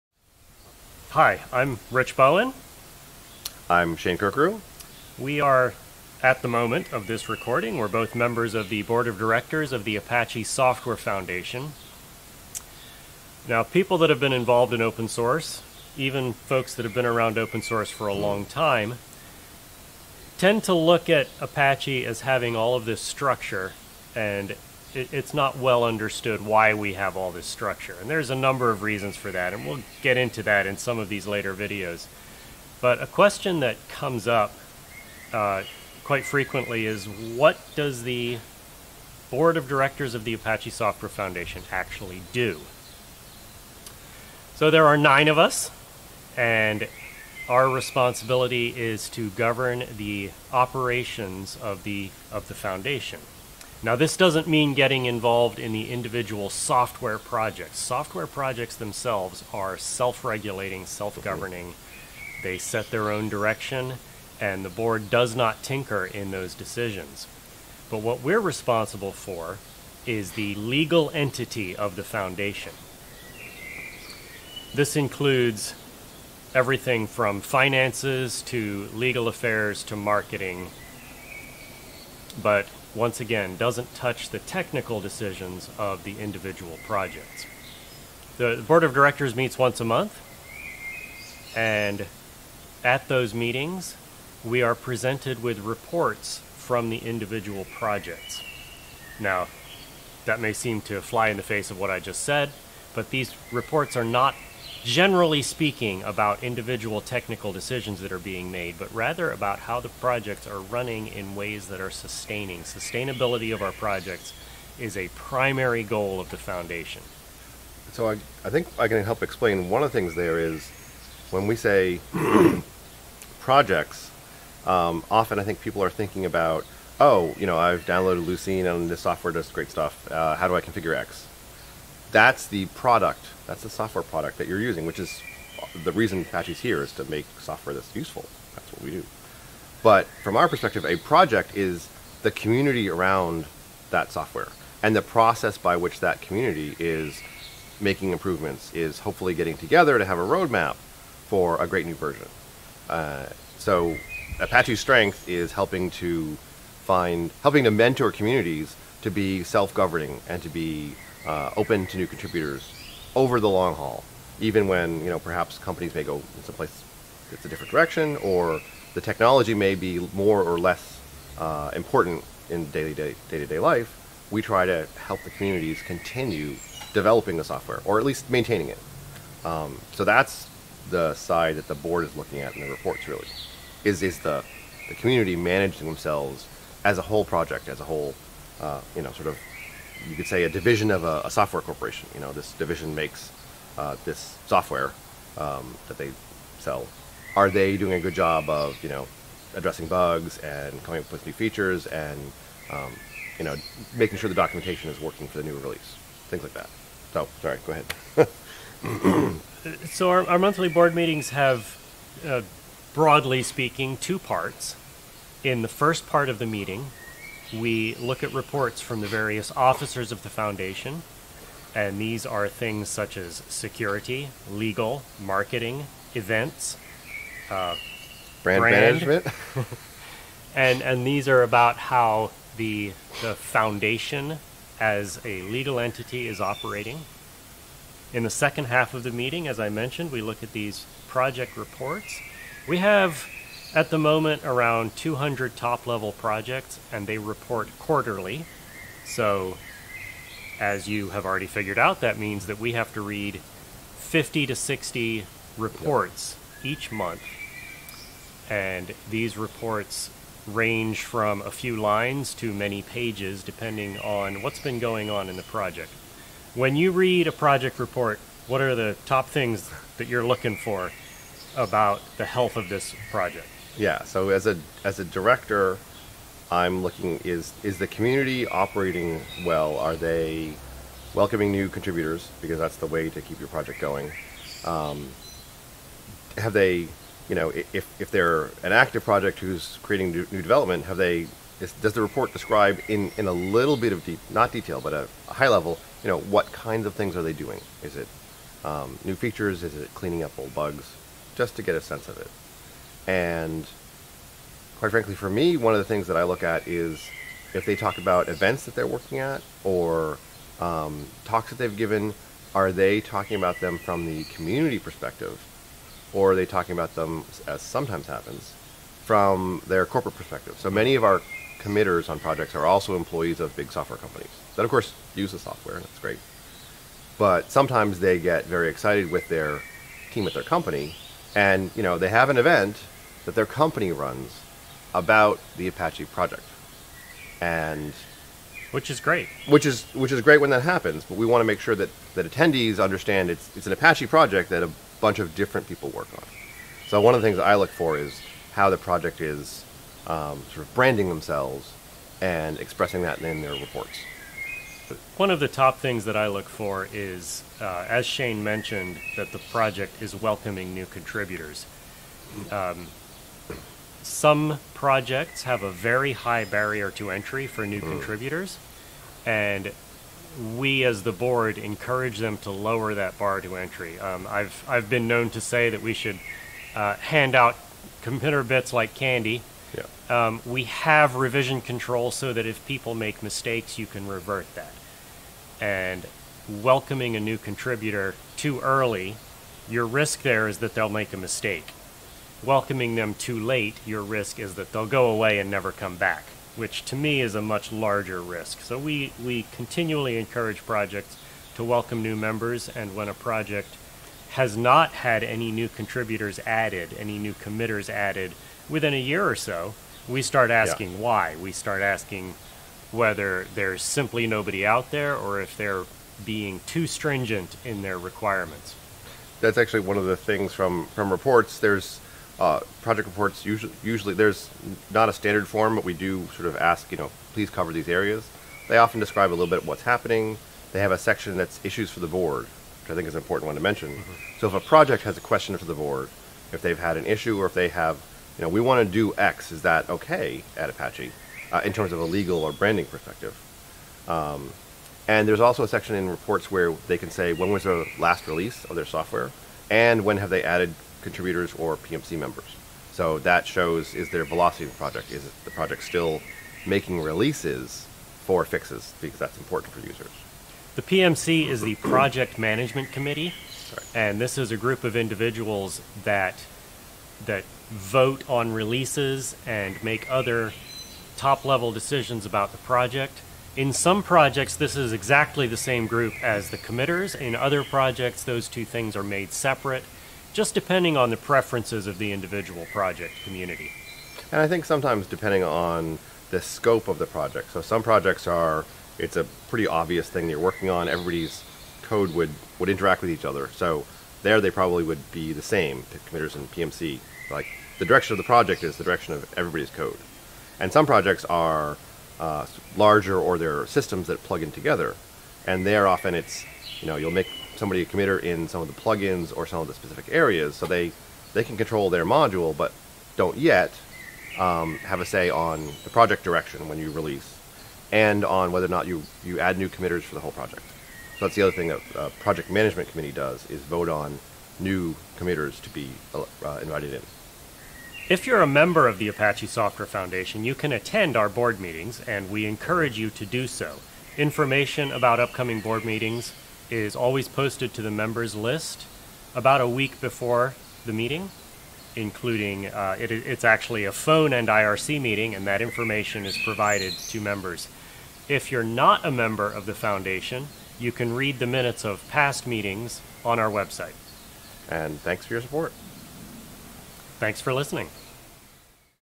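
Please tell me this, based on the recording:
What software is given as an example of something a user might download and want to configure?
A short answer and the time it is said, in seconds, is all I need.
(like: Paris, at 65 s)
Lucene, at 128 s.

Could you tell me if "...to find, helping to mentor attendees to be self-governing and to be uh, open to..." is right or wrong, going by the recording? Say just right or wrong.
wrong.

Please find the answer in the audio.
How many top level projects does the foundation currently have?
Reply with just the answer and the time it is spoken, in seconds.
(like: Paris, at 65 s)
Around 200, at 244 s.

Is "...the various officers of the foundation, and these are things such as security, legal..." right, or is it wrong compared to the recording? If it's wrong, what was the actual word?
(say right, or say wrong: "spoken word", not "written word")
right.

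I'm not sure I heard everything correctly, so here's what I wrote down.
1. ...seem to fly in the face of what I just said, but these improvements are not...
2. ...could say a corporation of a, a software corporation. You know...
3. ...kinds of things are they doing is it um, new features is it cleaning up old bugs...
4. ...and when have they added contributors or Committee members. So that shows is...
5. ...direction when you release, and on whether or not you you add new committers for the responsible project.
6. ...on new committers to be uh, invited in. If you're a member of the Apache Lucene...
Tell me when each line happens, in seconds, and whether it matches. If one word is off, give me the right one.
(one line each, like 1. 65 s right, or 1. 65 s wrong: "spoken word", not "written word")
1. 100 s wrong: "reports", not "improvements"
2. 190 s wrong: "division", not "corporation"
3. 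296 s right
4. 449 s wrong: "PMC", not "Committee"
5. 516 s wrong: "whole", not "responsible"
6. 523 s wrong: "Software", not "Lucene".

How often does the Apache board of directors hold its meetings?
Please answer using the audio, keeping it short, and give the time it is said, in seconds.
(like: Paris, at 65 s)
Once a month, at 89 s.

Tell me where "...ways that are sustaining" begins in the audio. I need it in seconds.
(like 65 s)
111 s.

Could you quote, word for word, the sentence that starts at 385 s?
And welcoming a new contributor too early, your risk there is that they'll make a mistake.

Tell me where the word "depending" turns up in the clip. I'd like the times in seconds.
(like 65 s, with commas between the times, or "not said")
263 s, 480 s, 485 s.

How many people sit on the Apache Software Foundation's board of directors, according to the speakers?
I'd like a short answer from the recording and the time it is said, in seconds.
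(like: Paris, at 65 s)
9, at 44 s.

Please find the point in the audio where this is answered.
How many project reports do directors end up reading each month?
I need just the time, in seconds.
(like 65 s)
253 s.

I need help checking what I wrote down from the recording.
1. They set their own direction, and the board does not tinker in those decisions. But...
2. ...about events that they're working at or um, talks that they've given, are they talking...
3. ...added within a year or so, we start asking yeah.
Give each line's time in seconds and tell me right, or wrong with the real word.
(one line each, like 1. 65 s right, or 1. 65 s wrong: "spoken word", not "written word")
1. 62 s right
2. 307 s right
3. 407 s right.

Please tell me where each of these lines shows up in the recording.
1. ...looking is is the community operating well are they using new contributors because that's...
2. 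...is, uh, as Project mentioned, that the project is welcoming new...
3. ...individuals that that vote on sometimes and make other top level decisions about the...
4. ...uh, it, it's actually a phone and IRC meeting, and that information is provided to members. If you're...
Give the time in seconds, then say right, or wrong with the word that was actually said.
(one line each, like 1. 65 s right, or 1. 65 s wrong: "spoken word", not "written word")
1. 276 s wrong: "welcoming", not "using"
2. 356 s wrong: "Shane", not "Project"
3. 464 s wrong: "releases", not "sometimes"
4. 542 s right.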